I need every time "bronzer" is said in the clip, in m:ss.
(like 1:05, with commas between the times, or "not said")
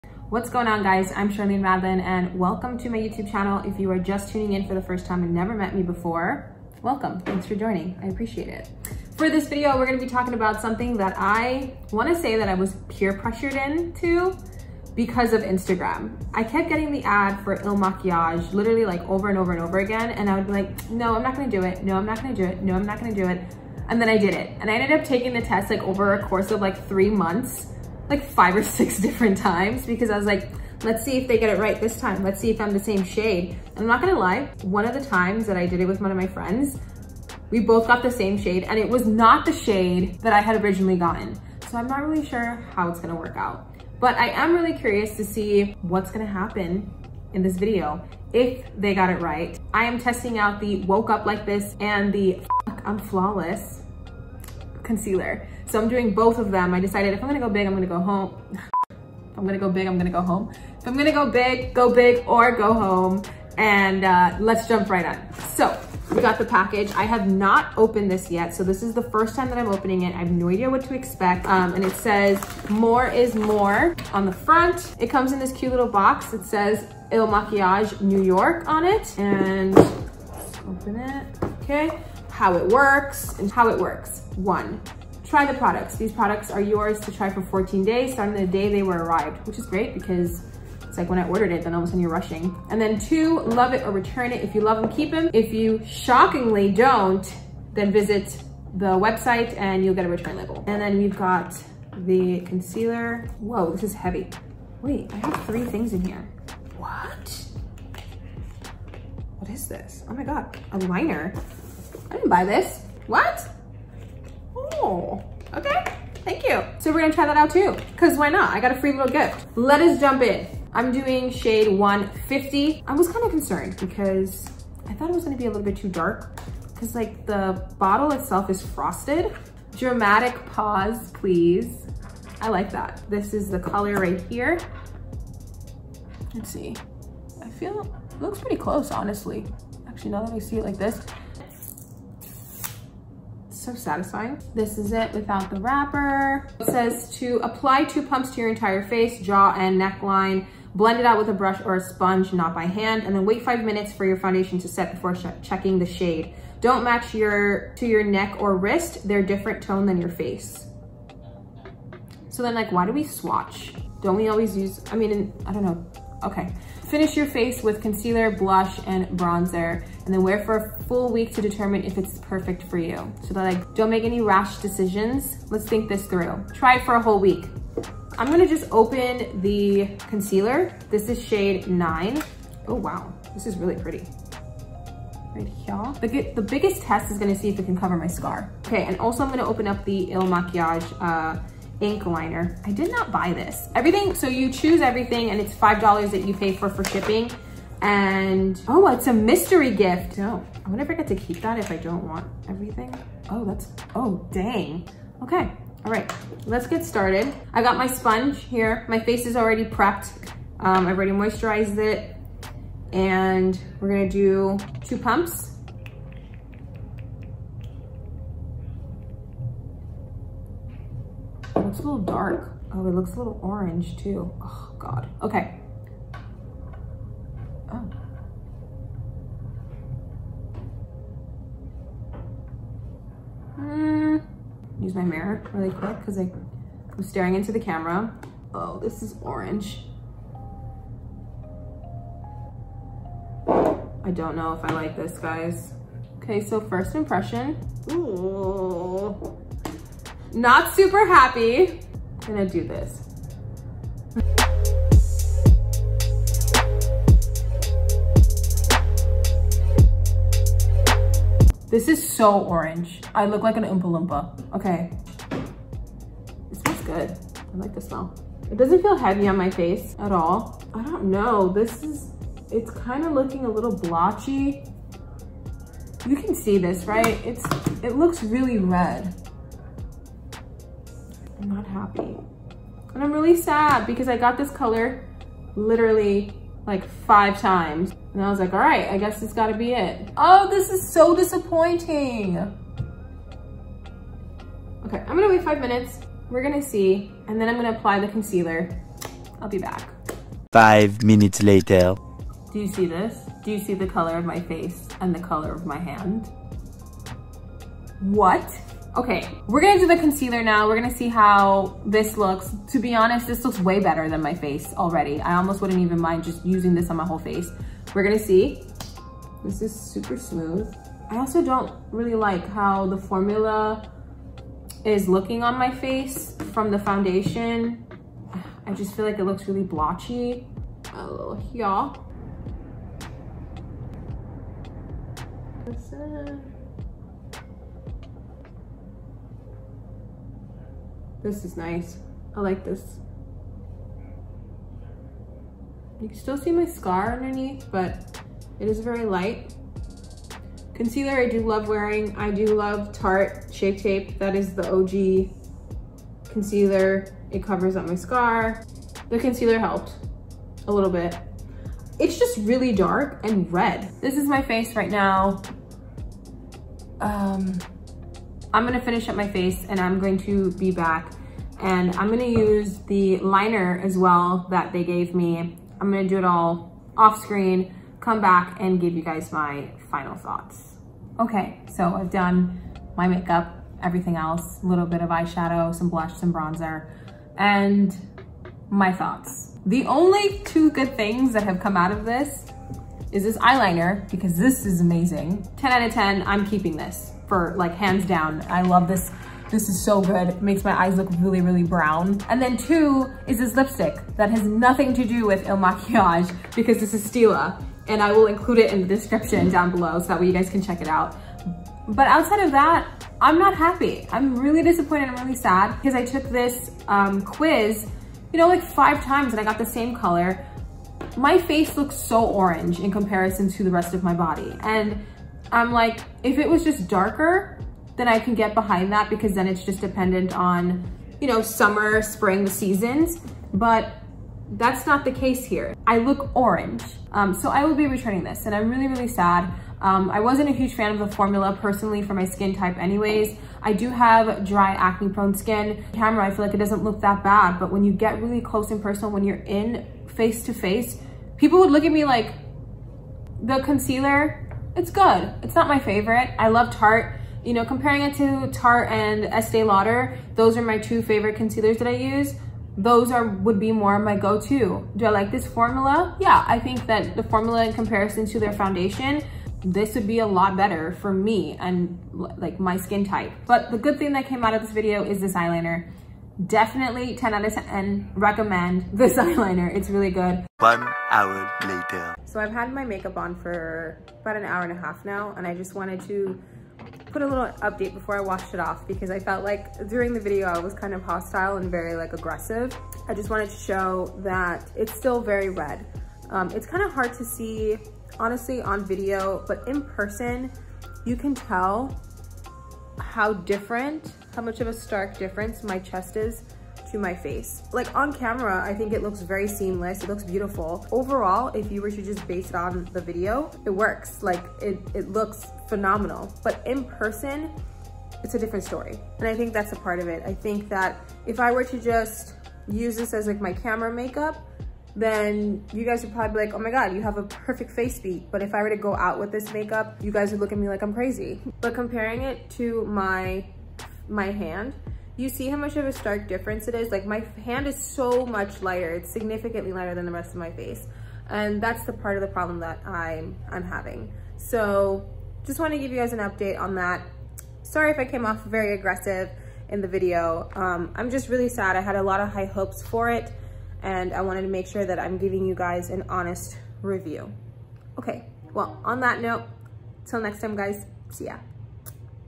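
2:49, 6:26.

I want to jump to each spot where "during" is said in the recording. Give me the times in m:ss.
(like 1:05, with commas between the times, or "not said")
8:09.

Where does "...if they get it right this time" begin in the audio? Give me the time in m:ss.
0:31.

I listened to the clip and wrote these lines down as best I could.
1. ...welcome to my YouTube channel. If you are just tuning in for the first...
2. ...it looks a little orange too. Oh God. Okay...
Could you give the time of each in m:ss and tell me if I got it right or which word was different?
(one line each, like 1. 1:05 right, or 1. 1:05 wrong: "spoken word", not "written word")
1. 0:02 right
2. 3:42 right.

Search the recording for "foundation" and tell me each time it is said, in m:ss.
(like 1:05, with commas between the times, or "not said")
2:34, 5:26, 7:48.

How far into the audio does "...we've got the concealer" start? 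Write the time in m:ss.
1:40.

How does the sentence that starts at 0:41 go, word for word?
So I'm not really sure how it's gonna work out.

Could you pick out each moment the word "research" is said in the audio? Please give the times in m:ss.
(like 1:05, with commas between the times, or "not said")
not said.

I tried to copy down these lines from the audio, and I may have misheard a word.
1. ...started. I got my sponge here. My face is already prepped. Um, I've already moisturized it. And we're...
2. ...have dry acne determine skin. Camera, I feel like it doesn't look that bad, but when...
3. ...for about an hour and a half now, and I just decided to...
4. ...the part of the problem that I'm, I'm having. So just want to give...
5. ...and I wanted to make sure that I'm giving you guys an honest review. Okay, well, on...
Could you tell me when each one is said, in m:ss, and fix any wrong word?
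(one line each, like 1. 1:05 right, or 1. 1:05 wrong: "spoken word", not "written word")
1. 3:26 right
2. 7:23 wrong: "prone", not "determine"
3. 8:03 wrong: "wanted", not "decided"
4. 9:01 right
5. 9:13 right.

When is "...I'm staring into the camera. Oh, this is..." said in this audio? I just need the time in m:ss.
3:56.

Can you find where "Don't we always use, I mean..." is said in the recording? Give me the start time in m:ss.
2:44.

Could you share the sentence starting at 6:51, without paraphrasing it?
But outside of that, I'm not happy.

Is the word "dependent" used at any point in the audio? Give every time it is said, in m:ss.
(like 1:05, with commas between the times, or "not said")
7:09.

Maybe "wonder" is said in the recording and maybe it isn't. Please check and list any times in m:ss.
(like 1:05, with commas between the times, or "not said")
3:20.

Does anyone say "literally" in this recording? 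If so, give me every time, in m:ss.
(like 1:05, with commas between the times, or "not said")
0:18, 4:45.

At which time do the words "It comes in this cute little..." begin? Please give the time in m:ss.
1:14.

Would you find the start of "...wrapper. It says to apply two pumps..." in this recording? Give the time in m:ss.
2:25.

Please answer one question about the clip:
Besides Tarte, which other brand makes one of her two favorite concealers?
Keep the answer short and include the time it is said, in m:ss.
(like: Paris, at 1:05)
Estee Lauder, at 7:39.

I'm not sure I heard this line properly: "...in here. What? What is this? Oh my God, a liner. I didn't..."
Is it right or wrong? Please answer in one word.
right.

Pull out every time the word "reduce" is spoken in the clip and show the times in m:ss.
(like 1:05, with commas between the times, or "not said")
not said.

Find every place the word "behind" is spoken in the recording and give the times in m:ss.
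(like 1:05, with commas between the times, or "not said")
7:08.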